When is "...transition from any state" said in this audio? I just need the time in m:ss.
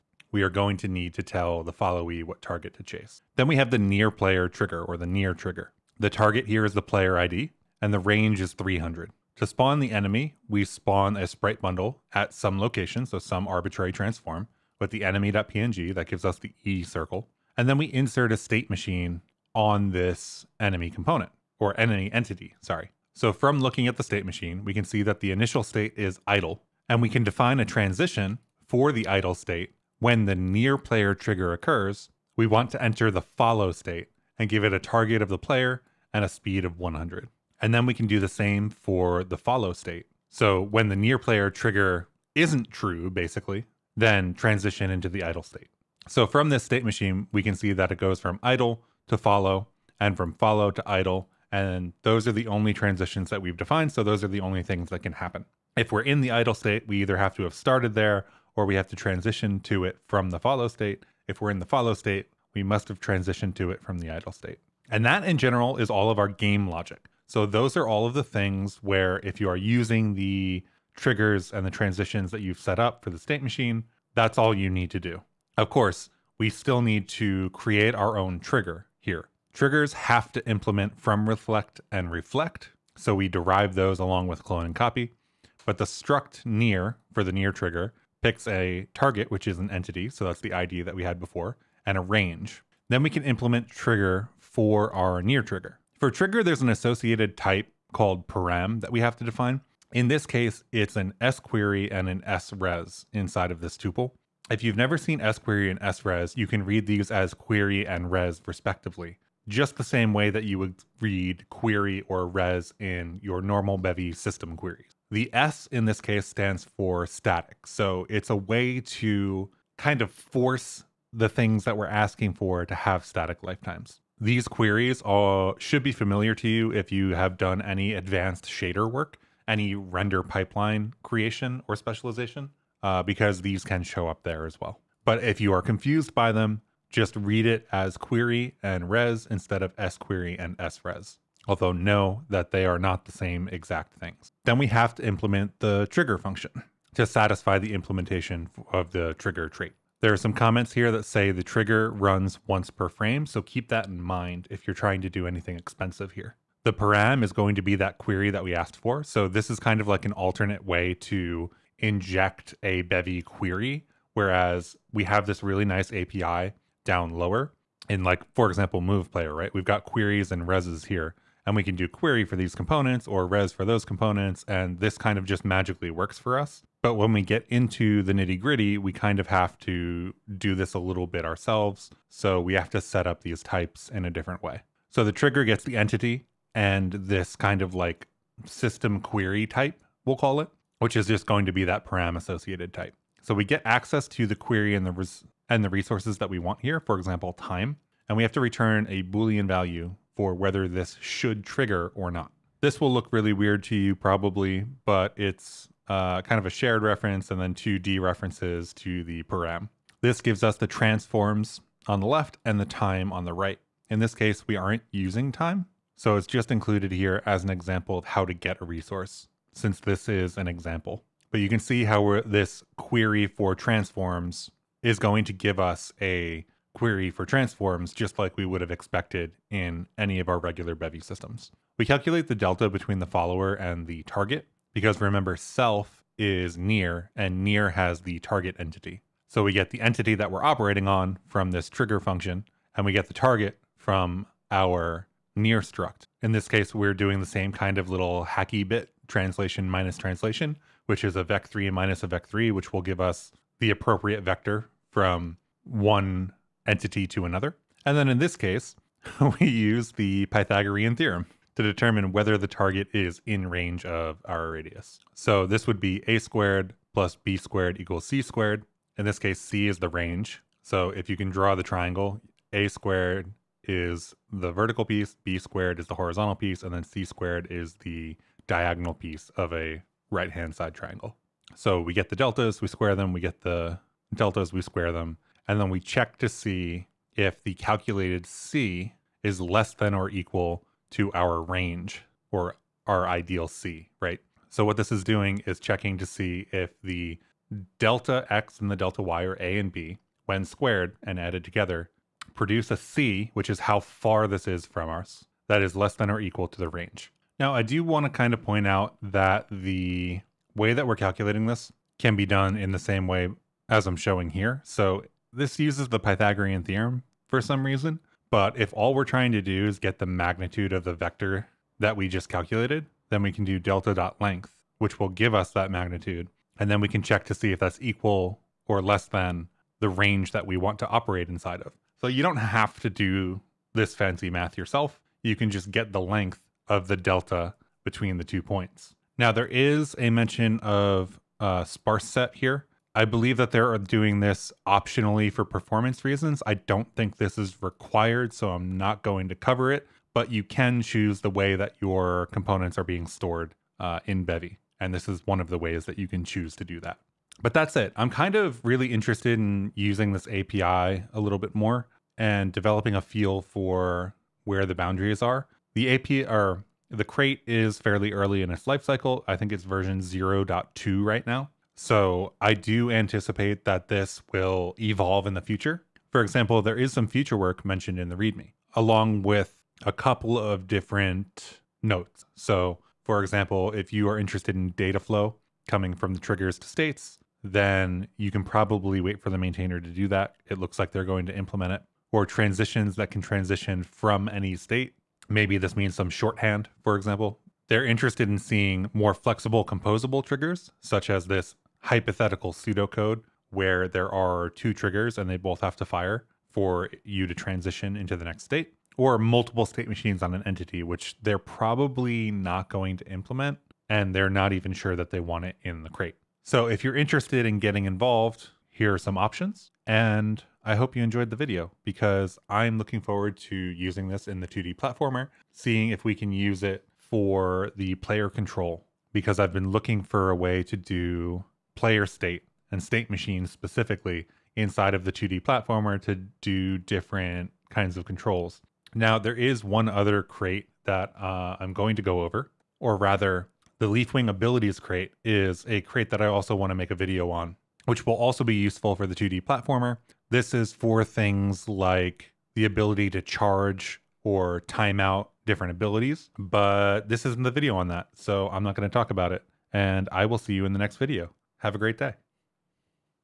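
6:33.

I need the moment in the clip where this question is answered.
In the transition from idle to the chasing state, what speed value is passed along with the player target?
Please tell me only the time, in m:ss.
0:36.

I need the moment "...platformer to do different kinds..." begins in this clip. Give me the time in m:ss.
7:15.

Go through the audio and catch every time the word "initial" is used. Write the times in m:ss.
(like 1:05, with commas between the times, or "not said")
0:25.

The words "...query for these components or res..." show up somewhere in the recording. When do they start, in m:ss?
2:51.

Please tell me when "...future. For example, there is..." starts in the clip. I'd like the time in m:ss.
6:15.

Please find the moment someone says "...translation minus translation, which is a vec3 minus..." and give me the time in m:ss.
4:09.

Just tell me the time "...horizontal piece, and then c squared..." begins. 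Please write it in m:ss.
4:35.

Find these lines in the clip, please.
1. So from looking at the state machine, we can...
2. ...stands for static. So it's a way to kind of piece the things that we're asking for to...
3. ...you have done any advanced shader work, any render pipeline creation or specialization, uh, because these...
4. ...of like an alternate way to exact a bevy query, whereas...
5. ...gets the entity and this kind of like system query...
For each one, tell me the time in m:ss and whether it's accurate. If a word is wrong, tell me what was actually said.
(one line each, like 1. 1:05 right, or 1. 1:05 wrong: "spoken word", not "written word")
1. 0:23 right
2. 1:56 wrong: "force", not "piece"
3. 2:06 right
4. 2:39 wrong: "inject", not "exact"
5. 3:05 right.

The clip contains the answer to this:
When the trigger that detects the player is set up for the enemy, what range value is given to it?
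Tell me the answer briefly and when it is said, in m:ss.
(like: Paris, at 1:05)
300, at 0:08.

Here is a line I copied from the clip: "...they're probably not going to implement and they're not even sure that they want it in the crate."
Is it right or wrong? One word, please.
right.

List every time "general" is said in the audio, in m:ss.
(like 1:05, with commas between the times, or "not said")
1:05.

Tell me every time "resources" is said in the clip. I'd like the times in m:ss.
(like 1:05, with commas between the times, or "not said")
3:15, 3:38.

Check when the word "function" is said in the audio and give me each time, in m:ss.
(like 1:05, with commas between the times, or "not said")
2:26, 4:01.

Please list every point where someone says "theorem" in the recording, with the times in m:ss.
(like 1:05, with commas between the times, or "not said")
4:20, 5:16.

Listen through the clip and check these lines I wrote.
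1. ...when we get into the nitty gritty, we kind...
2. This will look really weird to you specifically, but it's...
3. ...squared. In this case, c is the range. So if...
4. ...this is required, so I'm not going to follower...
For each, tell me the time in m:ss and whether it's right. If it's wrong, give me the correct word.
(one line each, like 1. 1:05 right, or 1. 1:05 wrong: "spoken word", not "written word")
1. 2:56 right
2. 3:22 wrong: "probably", not "specifically"
3. 4:28 right
4. 5:47 wrong: "cover", not "follower".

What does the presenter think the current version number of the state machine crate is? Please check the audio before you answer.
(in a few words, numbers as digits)
0.2.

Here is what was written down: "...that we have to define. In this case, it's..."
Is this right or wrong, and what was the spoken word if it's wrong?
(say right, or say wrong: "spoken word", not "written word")
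right.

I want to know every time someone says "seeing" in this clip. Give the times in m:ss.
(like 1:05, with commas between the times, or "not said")
6:38, 7:05.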